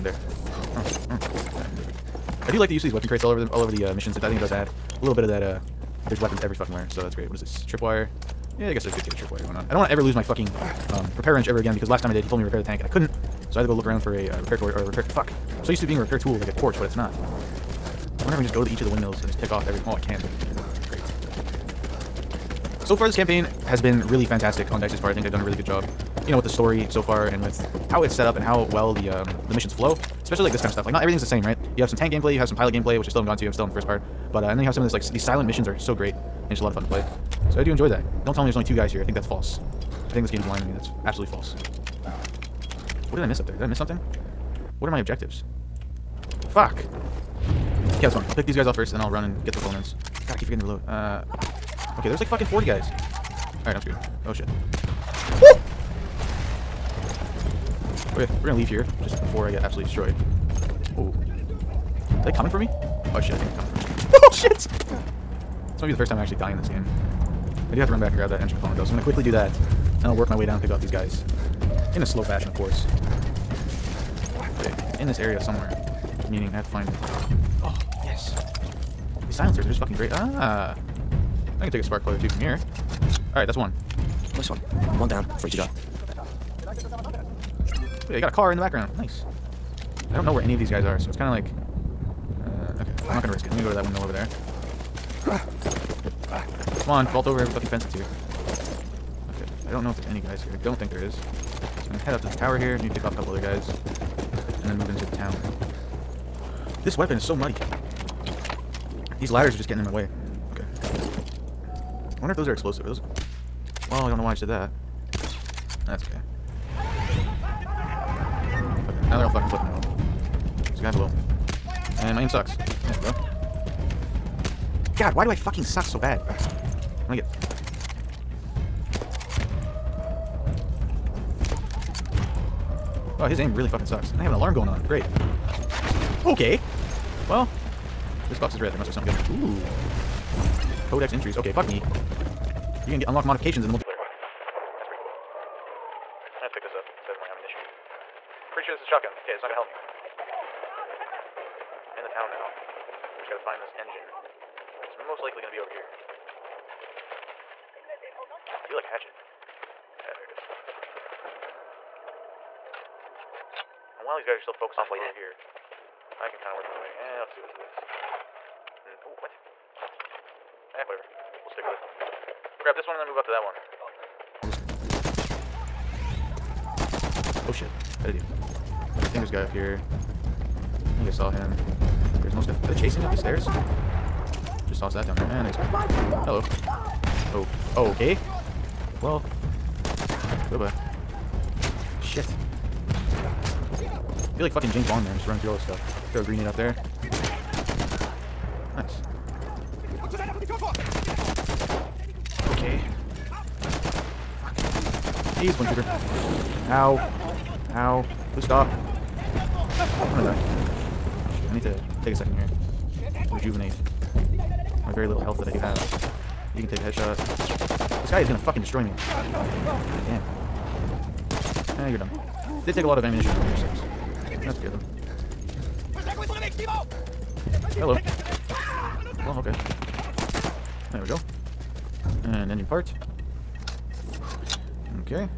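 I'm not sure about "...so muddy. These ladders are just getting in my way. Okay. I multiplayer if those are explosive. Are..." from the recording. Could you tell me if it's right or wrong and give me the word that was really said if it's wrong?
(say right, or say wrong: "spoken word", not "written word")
wrong: "wonder", not "multiplayer".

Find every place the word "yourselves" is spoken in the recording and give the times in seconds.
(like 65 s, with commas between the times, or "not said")
not said.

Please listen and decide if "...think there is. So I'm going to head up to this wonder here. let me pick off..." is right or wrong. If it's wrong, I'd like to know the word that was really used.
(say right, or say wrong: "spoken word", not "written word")
wrong: "tower", not "wonder".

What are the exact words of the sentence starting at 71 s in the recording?
In a slow fashion, of course.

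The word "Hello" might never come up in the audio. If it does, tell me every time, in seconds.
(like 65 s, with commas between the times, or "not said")
186 s, 227 s.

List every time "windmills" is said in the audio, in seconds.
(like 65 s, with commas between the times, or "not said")
18 s, 93 s.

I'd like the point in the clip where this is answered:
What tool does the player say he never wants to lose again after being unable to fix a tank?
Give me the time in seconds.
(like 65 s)
11 s.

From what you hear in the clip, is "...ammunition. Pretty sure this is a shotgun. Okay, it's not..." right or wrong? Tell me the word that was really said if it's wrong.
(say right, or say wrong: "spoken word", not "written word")
right.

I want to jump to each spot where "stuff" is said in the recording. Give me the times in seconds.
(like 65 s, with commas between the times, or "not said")
30 s, 195 s.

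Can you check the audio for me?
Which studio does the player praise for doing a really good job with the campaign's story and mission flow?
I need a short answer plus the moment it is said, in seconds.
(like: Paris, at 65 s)
DICE, at 24 s.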